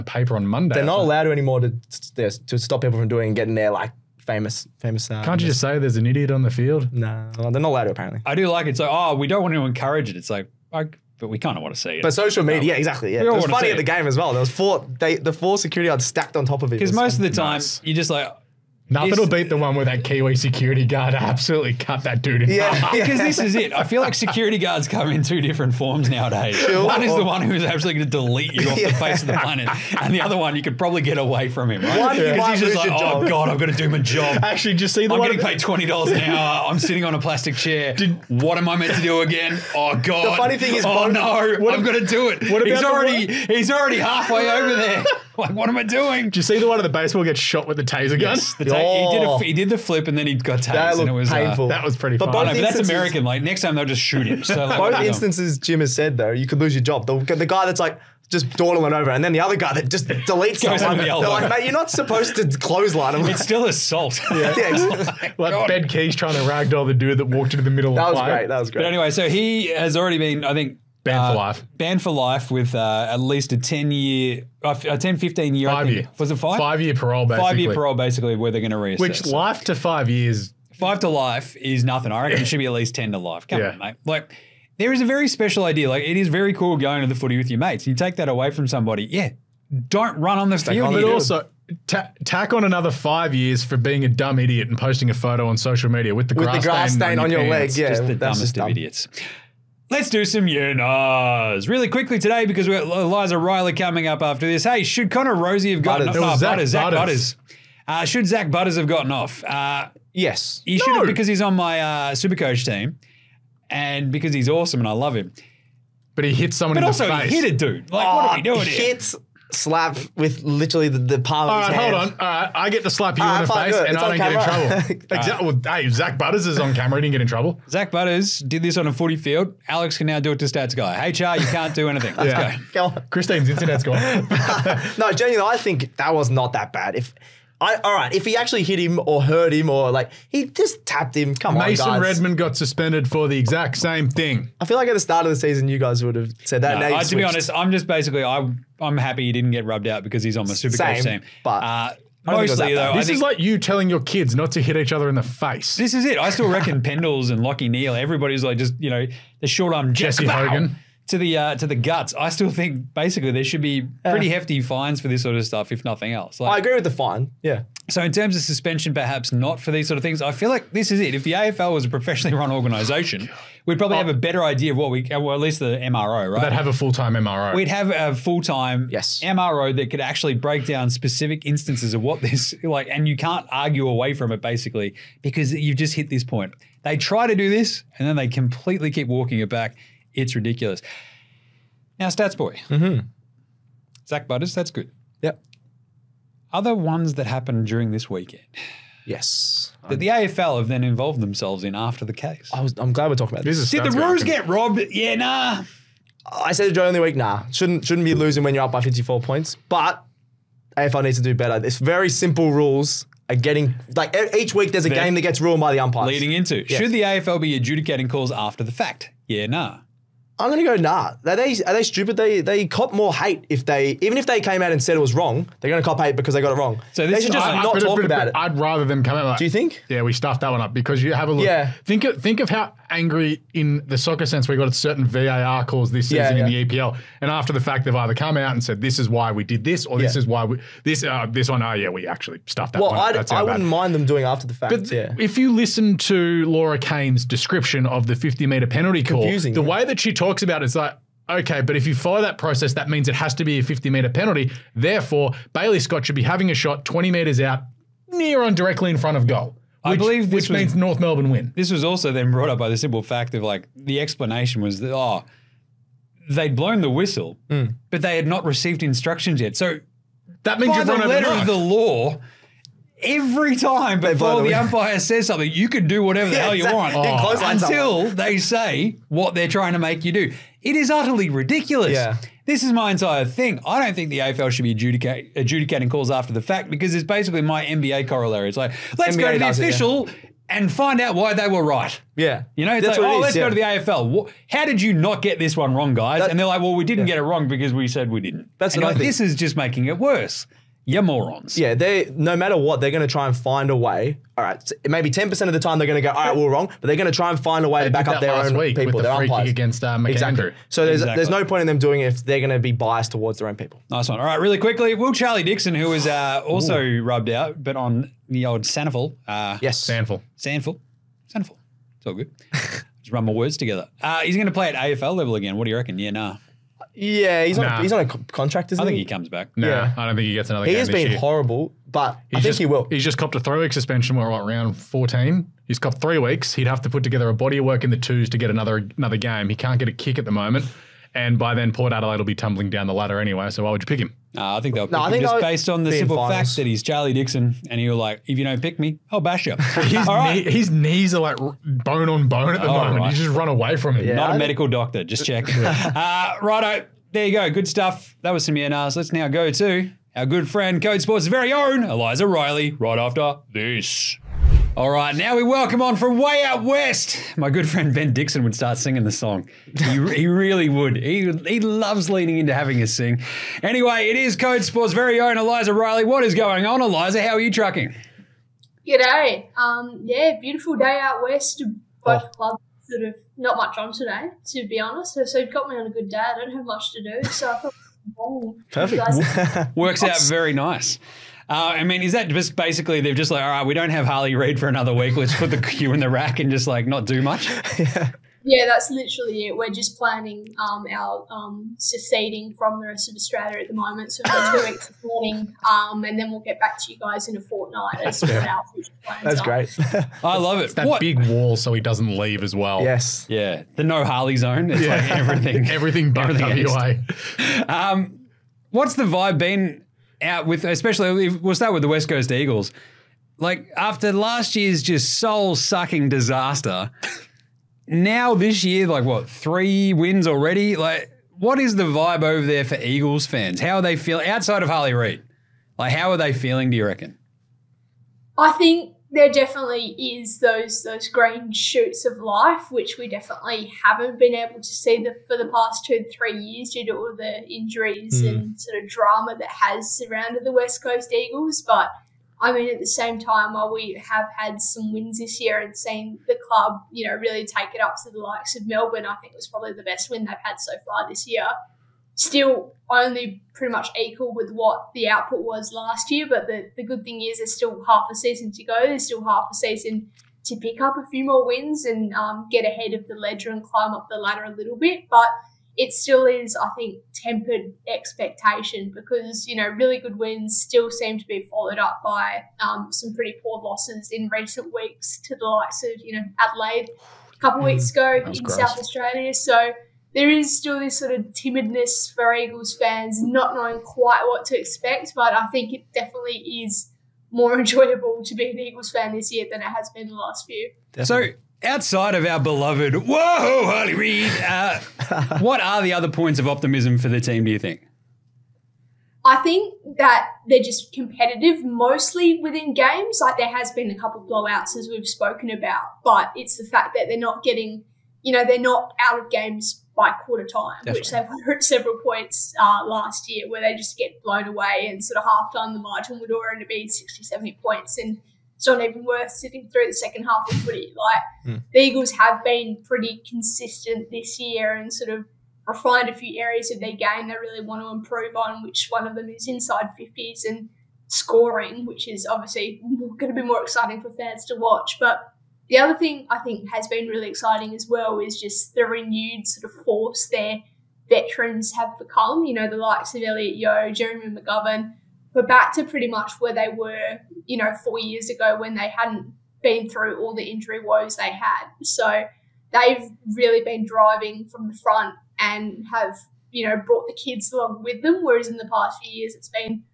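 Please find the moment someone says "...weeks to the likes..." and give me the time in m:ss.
8:04.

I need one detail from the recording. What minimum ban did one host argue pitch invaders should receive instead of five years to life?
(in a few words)
10 to life.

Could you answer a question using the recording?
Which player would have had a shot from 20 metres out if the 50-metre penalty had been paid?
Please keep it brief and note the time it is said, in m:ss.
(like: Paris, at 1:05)
Bailey Scott, at 4:15.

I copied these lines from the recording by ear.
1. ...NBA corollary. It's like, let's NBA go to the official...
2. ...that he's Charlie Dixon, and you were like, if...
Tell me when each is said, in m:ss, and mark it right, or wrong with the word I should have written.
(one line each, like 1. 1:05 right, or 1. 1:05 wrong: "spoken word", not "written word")
1. 4:47 right
2. 5:46 right.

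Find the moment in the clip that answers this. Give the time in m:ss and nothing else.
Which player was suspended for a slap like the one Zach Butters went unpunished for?
2:21.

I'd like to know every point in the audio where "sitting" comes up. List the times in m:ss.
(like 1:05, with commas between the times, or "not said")
0:36, 8:49.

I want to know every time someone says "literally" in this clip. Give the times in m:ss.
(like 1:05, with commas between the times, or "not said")
2:00, 6:38.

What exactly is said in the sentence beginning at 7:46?
But the, the good thing is there's still half a season to go.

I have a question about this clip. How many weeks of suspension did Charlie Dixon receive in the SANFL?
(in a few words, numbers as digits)
3.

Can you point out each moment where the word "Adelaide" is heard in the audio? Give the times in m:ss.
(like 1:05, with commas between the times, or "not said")
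5:41, 8:06.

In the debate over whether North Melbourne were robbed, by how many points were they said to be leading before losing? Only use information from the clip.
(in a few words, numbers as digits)
54.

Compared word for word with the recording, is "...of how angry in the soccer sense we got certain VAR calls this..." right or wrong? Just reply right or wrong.
right.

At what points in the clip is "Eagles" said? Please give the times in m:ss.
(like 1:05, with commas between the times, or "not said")
7:02, 7:12, 7:31, 8:12, 8:18, 8:51.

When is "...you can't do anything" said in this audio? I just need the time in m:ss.
2:11.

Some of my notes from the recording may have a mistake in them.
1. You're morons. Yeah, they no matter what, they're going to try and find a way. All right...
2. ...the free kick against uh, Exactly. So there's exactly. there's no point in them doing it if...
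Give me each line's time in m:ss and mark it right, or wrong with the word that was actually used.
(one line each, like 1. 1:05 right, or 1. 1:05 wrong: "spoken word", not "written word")
1. 5:00 right
2. 5:09 right.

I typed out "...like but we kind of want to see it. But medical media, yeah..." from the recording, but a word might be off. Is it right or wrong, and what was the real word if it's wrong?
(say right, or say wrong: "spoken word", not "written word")
wrong: "social", not "medical".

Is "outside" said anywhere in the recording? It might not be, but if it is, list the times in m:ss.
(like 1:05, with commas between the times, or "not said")
7:14, 8:21.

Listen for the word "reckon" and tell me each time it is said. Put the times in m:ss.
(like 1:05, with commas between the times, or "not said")
1:22, 2:36, 5:25, 7:16.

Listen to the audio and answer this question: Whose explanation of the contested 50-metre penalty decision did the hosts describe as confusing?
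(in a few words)
Laura Kane.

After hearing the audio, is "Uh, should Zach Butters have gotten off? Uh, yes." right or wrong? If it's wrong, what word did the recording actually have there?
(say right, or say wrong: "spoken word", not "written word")
right.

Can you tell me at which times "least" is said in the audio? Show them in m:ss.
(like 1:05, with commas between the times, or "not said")
1:13, 1:22, 2:55.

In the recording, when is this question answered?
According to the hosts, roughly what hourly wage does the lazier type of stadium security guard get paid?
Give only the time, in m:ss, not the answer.
0:35.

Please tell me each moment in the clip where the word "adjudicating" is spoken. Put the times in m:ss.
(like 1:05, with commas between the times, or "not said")
3:37, 4:44.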